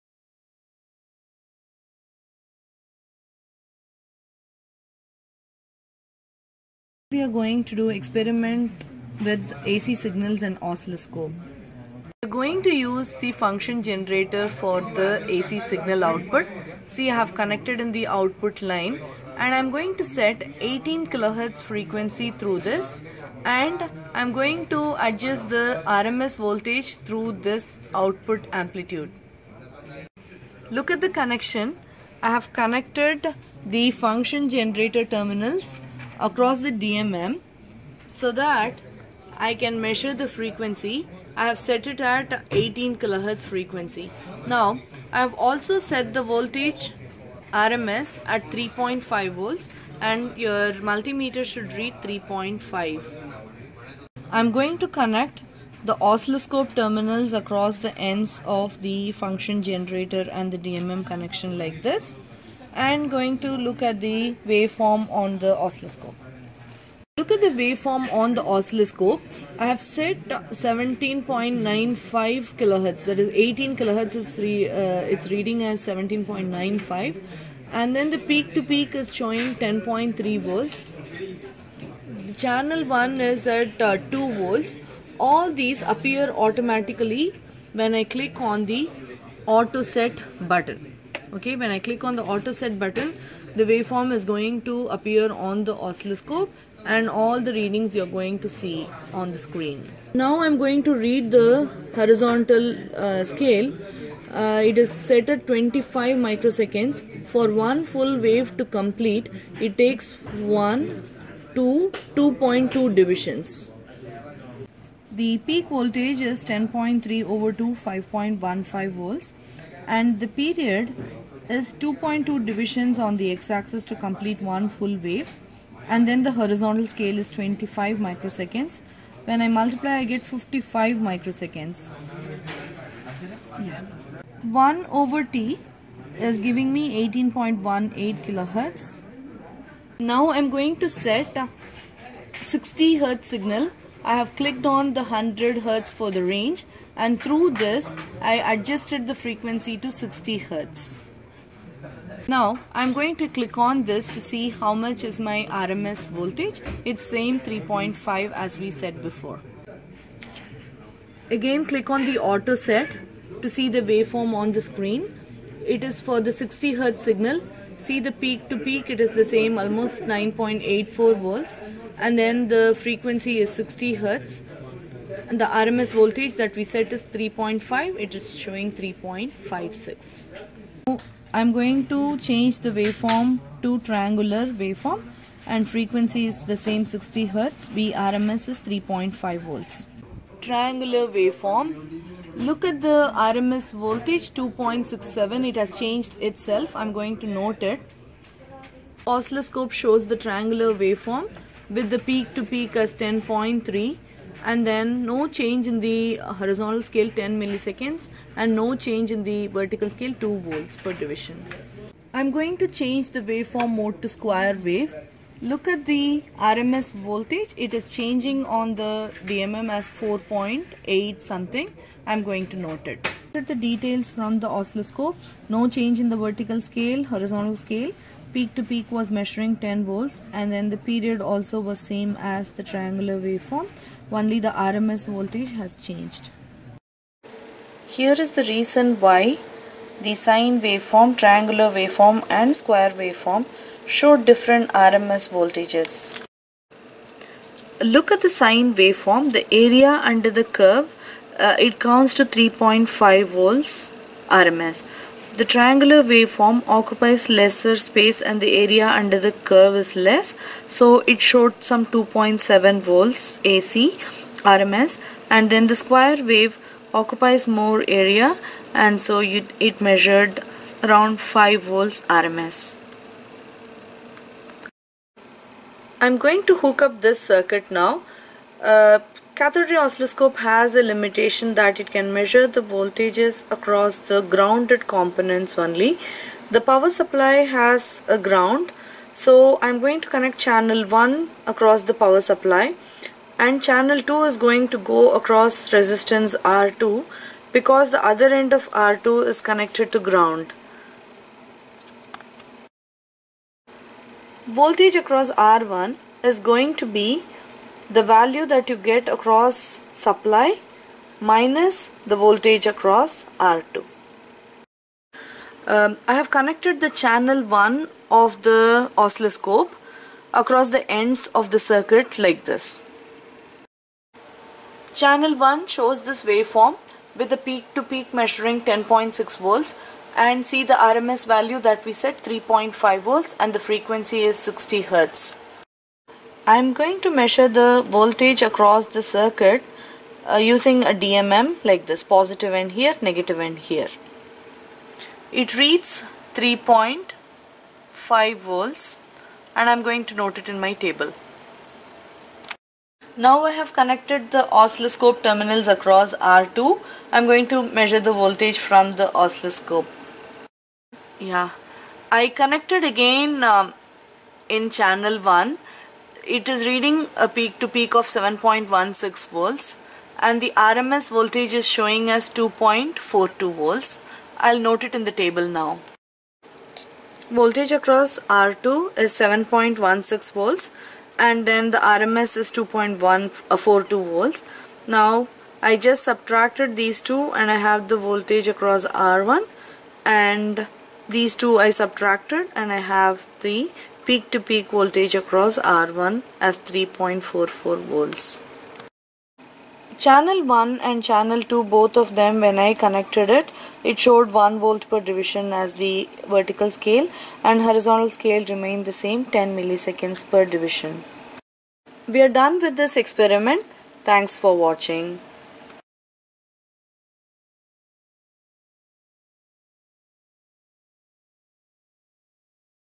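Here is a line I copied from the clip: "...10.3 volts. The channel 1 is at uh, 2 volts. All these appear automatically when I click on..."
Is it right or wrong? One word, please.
right.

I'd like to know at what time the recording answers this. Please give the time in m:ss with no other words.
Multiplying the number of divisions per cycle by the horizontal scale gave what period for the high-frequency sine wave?
2:10.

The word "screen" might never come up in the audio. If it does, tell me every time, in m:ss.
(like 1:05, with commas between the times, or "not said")
1:39, 2:44.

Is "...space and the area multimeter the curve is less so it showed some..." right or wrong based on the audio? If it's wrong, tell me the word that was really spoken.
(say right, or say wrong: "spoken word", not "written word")
wrong: "under", not "multimeter".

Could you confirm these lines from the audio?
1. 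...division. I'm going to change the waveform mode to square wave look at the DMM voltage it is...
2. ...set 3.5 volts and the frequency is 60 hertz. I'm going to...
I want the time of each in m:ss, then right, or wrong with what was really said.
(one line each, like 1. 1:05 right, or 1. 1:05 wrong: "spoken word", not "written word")
1. 3:30 wrong: "RMS", not "DMM"
2. 5:31 right.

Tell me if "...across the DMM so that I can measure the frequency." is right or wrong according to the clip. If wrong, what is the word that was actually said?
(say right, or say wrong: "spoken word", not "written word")
right.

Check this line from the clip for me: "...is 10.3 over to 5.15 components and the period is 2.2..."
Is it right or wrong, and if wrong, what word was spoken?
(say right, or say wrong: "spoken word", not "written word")
wrong: "volts", not "components".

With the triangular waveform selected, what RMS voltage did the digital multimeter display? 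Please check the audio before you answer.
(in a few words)
2.67.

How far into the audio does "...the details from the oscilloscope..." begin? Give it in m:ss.
3:43.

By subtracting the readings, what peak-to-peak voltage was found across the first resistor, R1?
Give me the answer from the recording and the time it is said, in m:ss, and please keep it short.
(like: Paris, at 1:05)
3.44 volts, at 6:36.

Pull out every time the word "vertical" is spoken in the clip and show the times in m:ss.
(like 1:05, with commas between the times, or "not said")
3:29, 3:46, 6:46.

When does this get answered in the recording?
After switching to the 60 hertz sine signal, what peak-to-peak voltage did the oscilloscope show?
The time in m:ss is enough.
2:50.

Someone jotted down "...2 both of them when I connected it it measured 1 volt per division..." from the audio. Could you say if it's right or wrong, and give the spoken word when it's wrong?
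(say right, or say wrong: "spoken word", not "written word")
wrong: "showed", not "measured".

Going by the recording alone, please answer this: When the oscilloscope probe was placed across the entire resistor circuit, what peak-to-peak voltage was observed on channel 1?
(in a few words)
10.6 volts.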